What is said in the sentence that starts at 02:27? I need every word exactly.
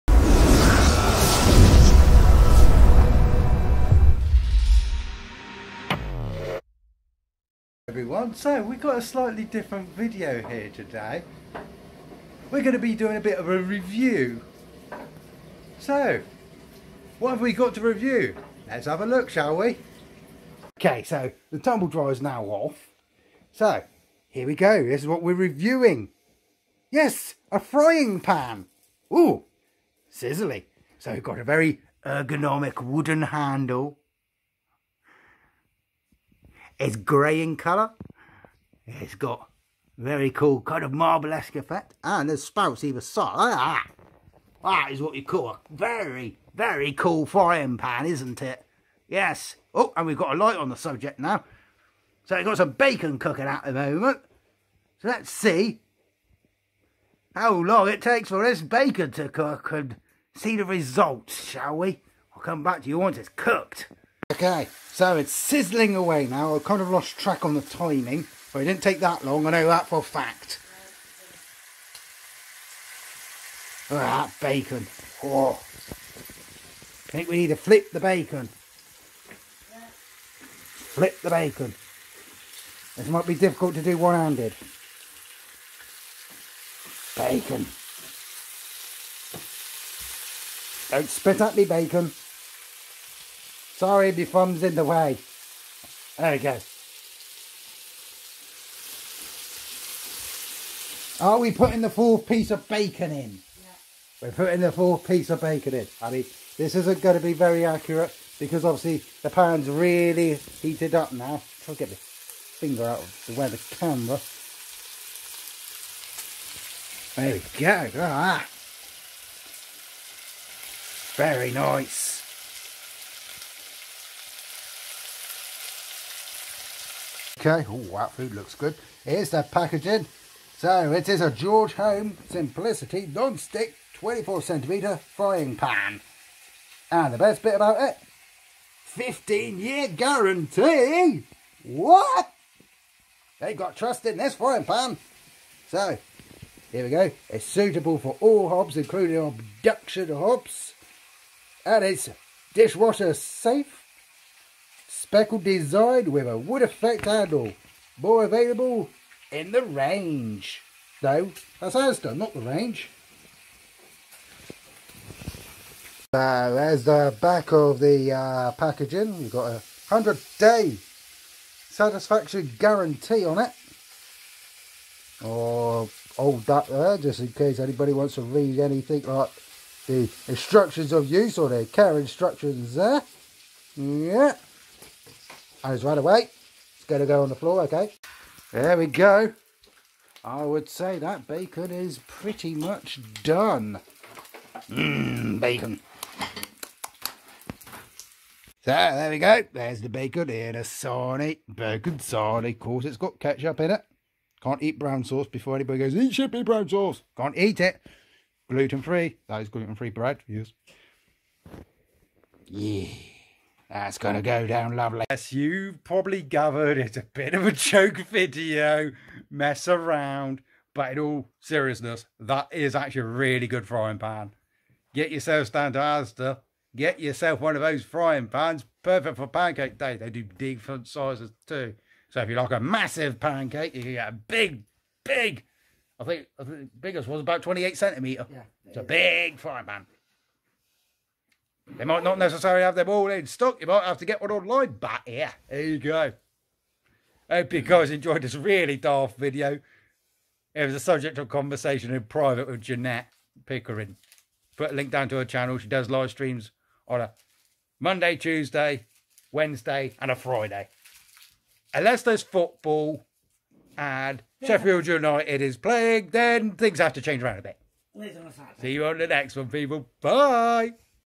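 It's suitable for all hobs, including induction hobs.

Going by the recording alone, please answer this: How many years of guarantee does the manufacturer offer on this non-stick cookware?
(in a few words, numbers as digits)
15 years.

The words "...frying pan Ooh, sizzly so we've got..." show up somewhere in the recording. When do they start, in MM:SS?
00:27.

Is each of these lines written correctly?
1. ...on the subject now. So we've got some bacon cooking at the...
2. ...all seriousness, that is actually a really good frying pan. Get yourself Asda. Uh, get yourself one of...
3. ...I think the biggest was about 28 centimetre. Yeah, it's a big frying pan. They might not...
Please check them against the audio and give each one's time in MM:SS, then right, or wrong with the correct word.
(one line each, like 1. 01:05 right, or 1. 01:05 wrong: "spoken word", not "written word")
1. 00:50 right
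2. 03:40 right
3. 03:56 right.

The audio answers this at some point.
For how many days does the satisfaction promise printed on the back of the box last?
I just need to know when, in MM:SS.
02:49.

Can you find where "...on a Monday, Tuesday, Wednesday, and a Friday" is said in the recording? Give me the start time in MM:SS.
04:16.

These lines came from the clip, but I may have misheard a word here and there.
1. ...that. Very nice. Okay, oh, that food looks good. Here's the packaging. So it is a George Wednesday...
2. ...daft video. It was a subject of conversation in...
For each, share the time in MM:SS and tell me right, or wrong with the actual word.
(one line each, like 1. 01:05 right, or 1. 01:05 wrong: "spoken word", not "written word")
1. 01:57 wrong: "Home", not "Wednesday"
2. 04:08 right.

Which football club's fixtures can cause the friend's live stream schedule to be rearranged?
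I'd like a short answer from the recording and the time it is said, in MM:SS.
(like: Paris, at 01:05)
Sheffield United, at 04:24.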